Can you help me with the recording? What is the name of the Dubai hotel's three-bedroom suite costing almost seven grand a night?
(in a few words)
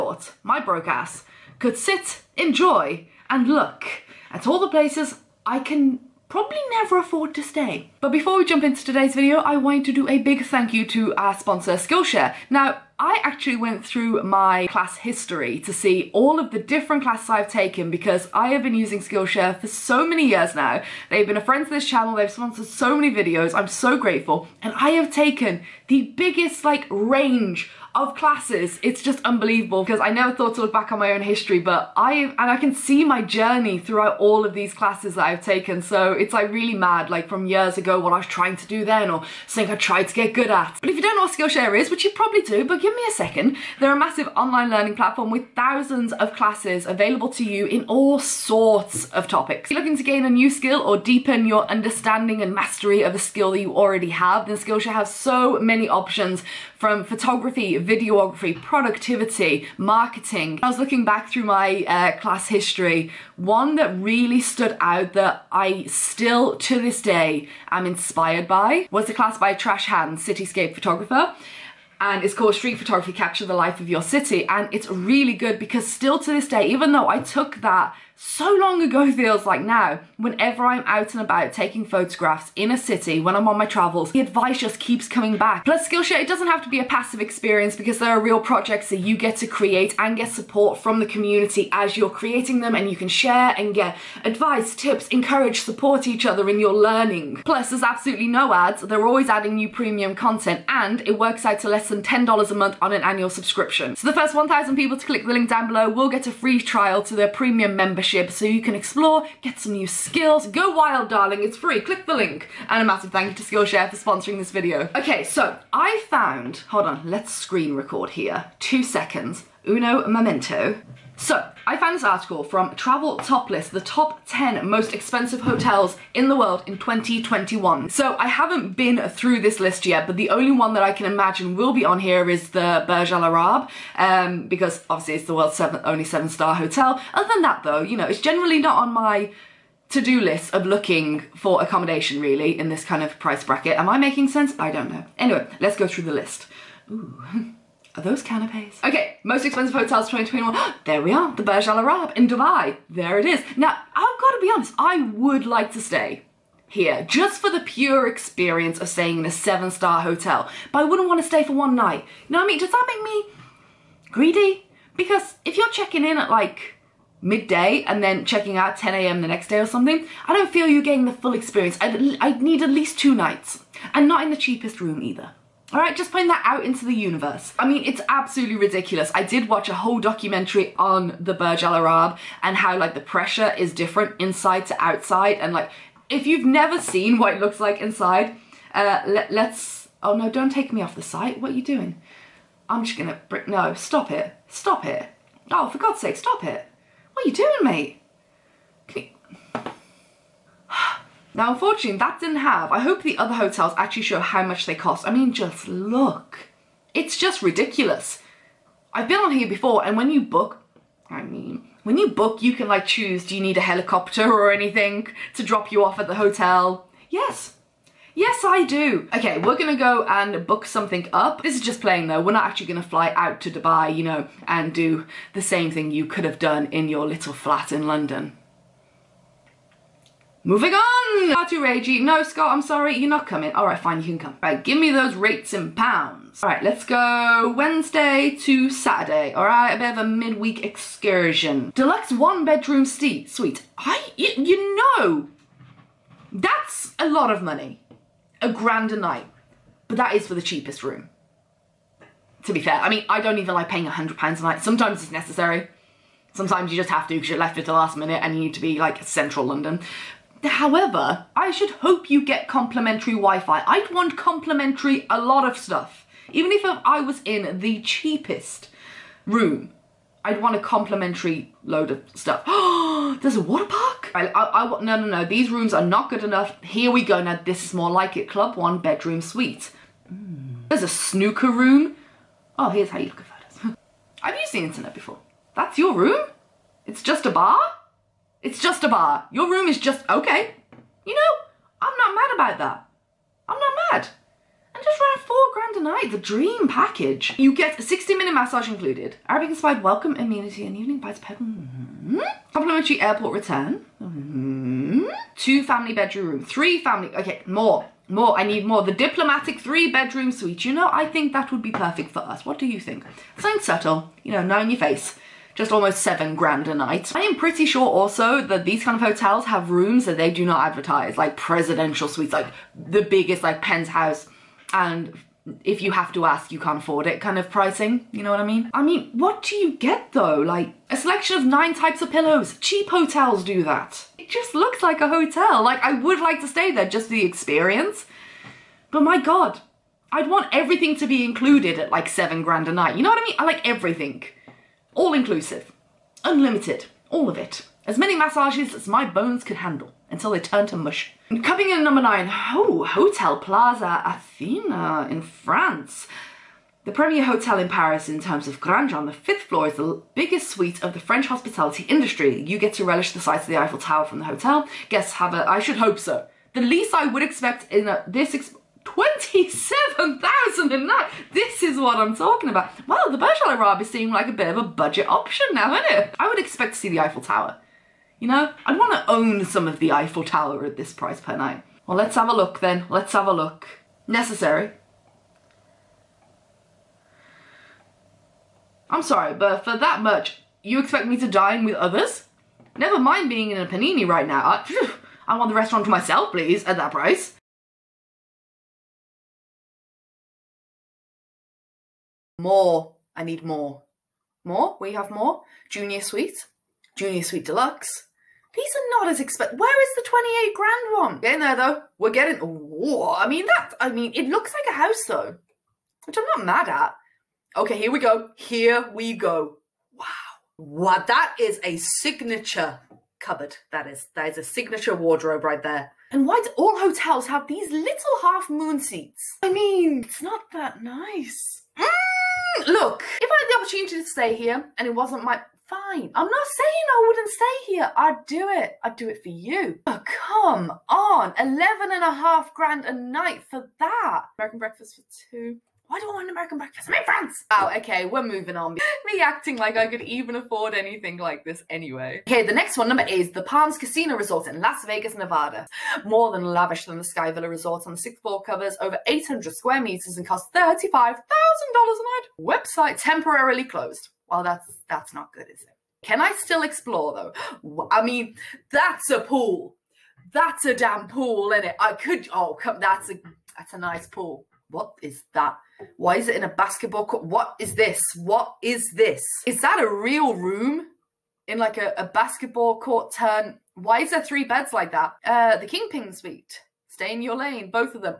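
The diplomatic three bedroom suite.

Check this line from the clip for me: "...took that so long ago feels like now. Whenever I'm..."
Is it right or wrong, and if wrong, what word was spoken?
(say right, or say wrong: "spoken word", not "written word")
right.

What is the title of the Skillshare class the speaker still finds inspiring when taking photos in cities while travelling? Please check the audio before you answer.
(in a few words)
Street Photography Capture the Life of Your City.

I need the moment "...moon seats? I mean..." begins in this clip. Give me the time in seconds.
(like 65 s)
428 s.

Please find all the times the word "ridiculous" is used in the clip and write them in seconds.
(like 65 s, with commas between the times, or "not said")
178 s, 207 s.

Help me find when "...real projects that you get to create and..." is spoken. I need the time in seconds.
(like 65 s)
88 s.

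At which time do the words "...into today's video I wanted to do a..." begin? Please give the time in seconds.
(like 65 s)
8 s.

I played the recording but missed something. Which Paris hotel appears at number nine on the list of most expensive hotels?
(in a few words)
Hotel Plaza Athena.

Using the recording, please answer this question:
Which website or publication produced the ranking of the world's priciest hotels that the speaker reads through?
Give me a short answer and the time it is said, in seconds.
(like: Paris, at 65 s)
Travel Top List, at 122 s.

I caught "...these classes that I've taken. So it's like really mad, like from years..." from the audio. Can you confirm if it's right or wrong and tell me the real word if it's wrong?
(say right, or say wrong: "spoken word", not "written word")
right.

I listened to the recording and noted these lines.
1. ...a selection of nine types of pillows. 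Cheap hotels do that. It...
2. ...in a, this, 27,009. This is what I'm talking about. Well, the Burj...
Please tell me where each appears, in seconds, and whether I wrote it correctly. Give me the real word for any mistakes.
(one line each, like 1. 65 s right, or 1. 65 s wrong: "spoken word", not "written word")
1. 330 s right
2. 367 s right.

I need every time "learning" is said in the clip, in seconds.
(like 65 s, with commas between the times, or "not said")
44 s, 96 s.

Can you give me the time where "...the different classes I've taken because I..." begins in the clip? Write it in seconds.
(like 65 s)
16 s.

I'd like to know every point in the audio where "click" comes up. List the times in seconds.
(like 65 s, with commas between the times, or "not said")
105 s, 111 s.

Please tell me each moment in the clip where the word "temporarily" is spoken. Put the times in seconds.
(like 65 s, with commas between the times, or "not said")
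463 s.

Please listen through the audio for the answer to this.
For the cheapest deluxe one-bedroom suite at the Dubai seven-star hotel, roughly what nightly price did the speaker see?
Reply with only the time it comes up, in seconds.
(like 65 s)
248 s.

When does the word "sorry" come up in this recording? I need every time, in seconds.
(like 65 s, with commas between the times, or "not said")
232 s, 389 s.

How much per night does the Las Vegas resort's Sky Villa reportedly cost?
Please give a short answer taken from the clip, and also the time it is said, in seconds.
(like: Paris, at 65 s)
$35,000, at 460 s.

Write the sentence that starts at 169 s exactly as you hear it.
the next day or something, I don't feel you getting the full experience.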